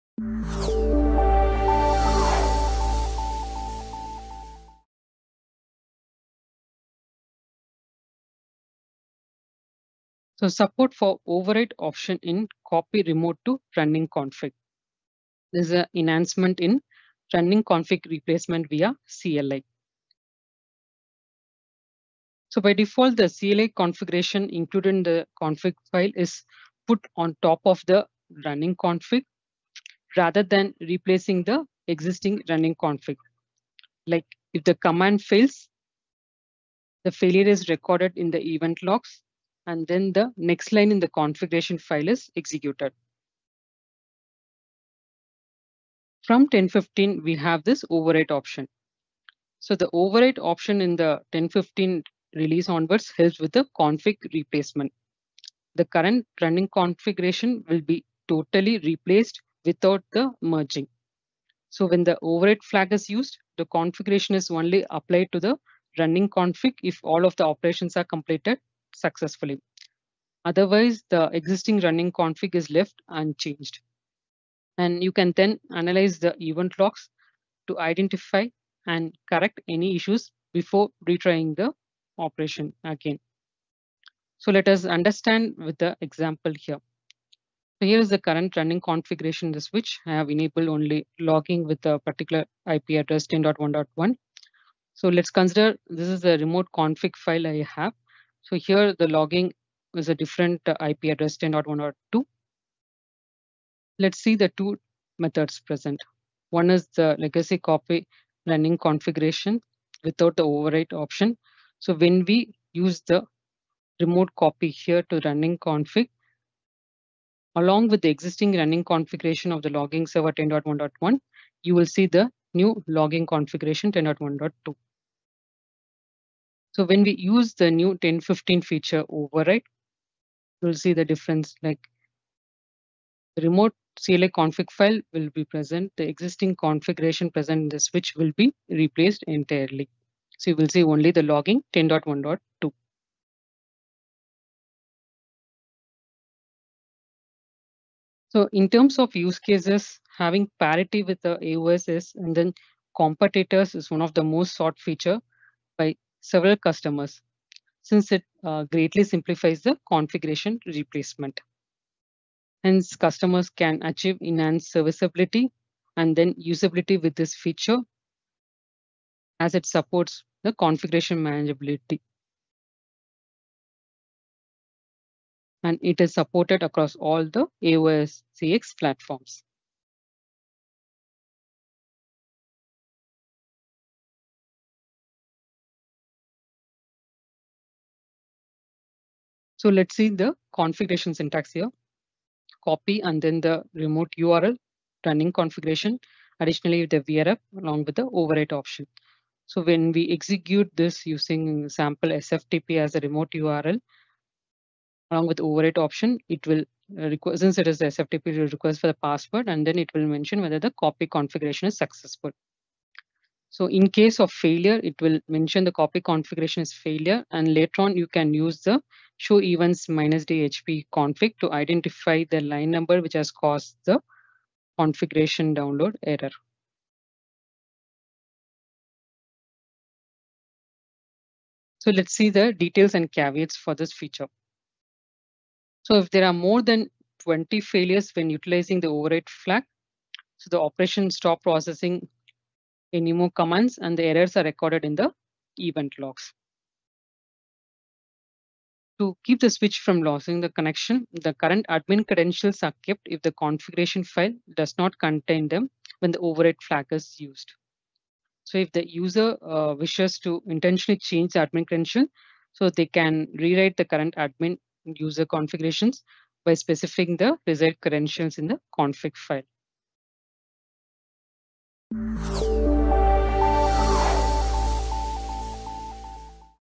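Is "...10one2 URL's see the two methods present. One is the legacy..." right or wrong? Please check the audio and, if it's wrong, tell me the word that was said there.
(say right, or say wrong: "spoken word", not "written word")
wrong: "Let", not "URL".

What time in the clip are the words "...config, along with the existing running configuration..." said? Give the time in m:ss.
1:55.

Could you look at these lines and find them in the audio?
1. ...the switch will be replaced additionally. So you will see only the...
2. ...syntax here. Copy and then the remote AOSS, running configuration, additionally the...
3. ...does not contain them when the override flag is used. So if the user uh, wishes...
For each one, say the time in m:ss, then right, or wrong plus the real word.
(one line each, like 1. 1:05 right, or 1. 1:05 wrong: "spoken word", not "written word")
1. 2:17 wrong: "entirely", not "additionally"
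2. 3:11 wrong: "URL", not "AOSS"
3. 4:14 right.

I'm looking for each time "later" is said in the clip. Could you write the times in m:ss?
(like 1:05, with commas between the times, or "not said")
3:37.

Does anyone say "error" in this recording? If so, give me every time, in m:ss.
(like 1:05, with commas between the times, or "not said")
3:46, 4:04.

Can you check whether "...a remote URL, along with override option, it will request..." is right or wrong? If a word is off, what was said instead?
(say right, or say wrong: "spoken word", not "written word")
right.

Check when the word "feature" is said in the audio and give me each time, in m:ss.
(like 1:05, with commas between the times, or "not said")
2:08, 2:34, 2:47, 3:53.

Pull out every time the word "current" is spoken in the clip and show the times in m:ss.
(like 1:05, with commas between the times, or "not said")
0:55, 1:28, 4:11, 4:23.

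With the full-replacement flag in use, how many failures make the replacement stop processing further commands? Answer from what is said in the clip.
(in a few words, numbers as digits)
More than 20.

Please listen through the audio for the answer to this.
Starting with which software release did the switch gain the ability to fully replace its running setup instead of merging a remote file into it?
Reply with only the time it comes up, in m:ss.
0:51.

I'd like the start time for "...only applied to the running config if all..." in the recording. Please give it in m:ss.
1:04.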